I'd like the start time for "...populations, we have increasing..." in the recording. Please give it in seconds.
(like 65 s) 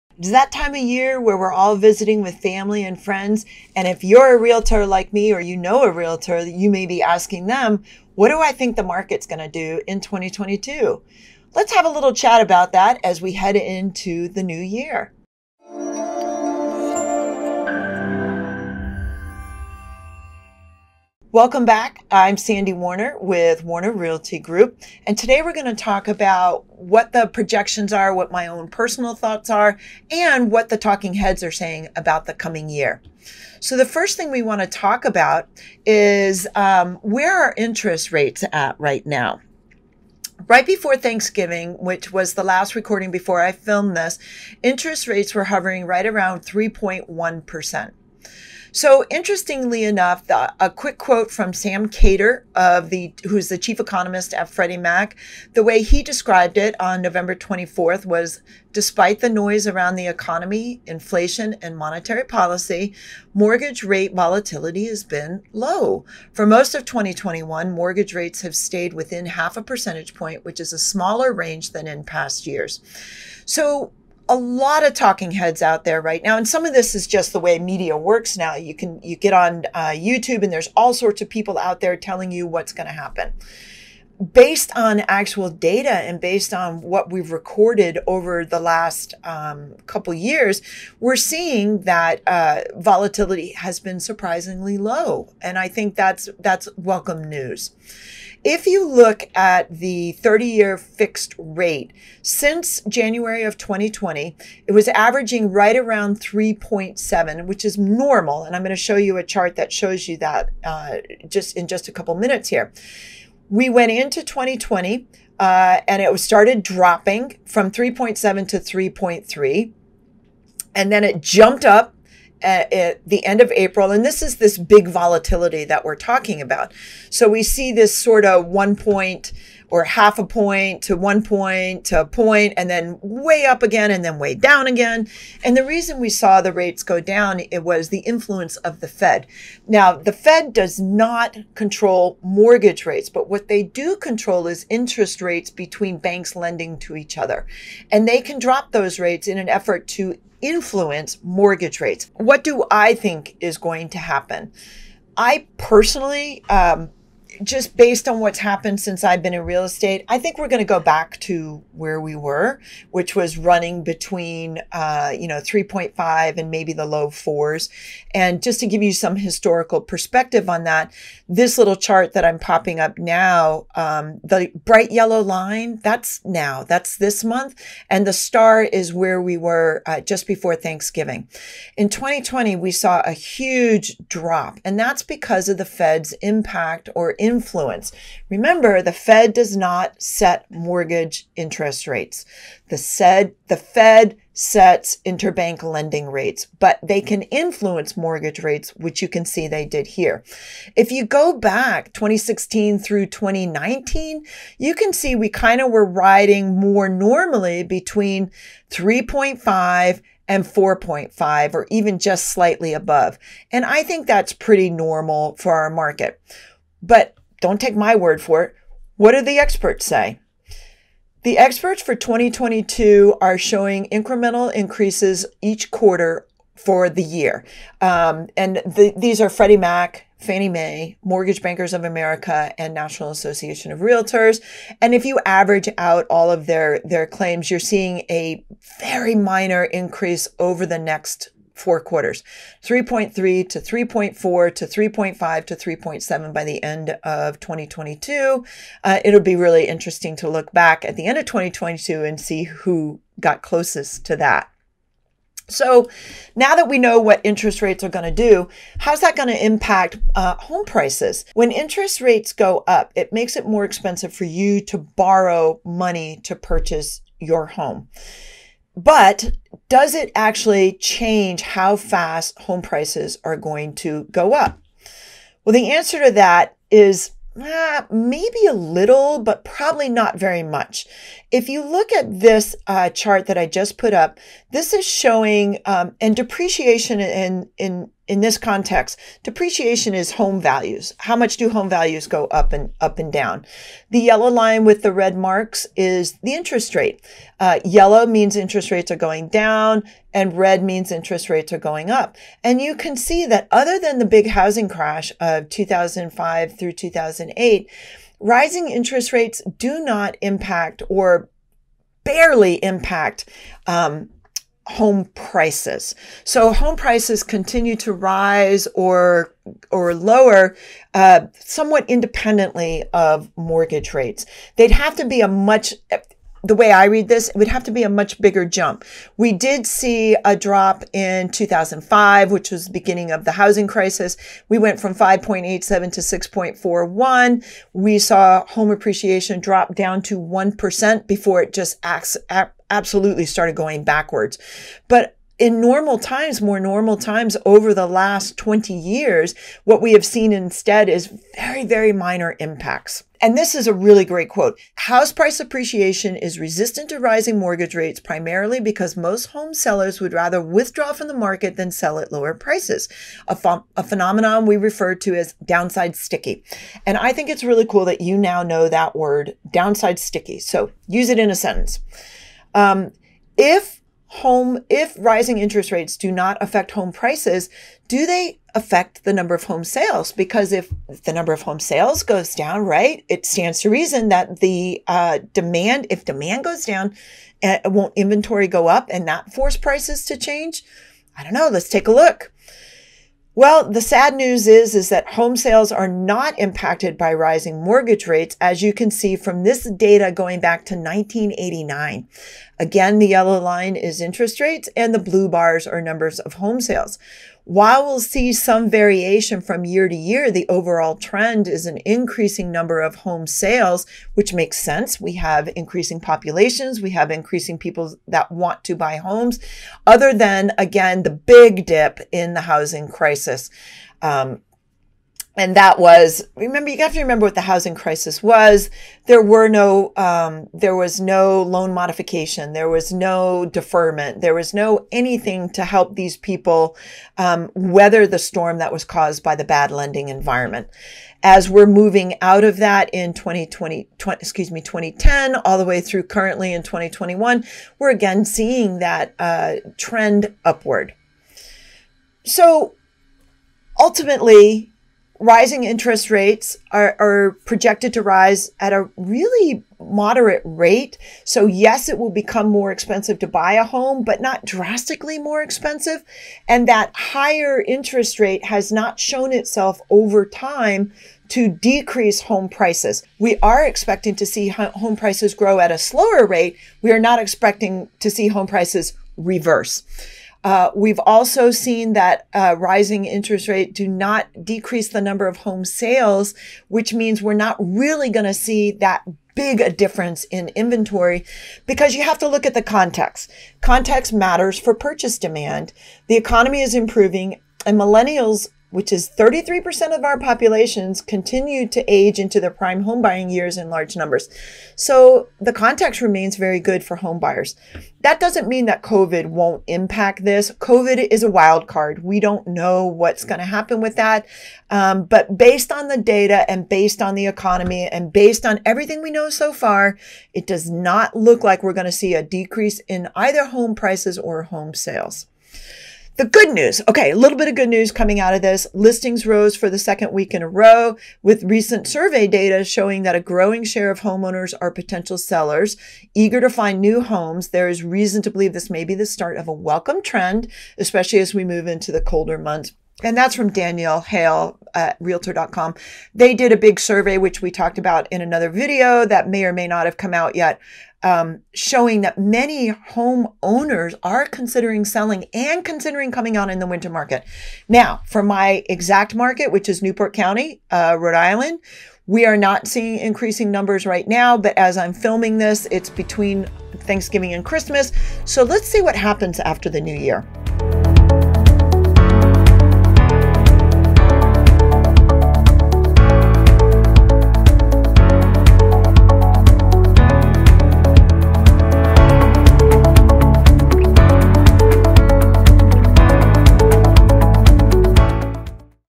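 415 s.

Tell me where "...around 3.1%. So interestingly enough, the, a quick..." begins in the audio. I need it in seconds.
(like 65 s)
46 s.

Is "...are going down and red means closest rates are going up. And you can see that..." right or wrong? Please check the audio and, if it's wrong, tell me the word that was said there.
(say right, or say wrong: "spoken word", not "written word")
wrong: "interest", not "closest".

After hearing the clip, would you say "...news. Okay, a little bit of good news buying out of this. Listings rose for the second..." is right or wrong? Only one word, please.
wrong.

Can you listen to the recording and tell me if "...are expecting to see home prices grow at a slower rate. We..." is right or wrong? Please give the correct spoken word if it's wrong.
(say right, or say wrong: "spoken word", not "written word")
right.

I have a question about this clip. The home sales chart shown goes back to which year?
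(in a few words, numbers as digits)
1989.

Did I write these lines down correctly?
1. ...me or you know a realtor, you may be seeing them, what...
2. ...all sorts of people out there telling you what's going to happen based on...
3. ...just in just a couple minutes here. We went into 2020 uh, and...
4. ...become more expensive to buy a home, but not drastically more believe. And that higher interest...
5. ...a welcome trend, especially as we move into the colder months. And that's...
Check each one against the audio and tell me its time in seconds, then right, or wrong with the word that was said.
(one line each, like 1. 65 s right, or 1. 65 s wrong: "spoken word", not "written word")
1. 5 s wrong: "asking", not "seeing"
2. 80 s right
3. 111 s right
4. 462 s wrong: "expensive", not "believe"
5. 539 s right.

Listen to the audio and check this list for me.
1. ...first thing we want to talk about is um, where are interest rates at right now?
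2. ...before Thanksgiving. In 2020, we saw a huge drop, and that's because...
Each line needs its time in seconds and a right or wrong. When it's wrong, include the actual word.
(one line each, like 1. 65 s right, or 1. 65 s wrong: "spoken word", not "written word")
1. 33 s right
2. 180 s right.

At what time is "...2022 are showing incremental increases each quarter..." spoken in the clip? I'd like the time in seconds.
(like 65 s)
221 s.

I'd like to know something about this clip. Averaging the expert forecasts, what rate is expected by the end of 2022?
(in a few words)
3.7.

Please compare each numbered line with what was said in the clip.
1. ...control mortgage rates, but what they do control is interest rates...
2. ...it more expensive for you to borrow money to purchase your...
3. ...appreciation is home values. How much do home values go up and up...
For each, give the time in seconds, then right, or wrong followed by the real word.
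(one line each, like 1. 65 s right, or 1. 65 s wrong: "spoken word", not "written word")
1. 141 s right
2. 263 s right
3. 289 s wrong: "depreciation", not "appreciation".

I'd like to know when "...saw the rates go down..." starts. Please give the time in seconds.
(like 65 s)
136 s.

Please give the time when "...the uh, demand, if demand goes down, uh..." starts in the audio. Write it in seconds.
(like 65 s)
384 s.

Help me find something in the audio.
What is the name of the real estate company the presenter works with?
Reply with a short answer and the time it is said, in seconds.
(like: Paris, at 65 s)
Warner Realty Group, at 23 s.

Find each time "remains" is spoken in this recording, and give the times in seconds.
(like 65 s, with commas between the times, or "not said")
505 s.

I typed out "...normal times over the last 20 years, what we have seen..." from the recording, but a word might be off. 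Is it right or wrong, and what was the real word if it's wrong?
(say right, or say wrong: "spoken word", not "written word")
right.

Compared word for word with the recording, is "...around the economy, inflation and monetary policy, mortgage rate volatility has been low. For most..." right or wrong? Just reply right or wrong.
right.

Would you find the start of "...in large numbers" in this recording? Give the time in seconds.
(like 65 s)
503 s.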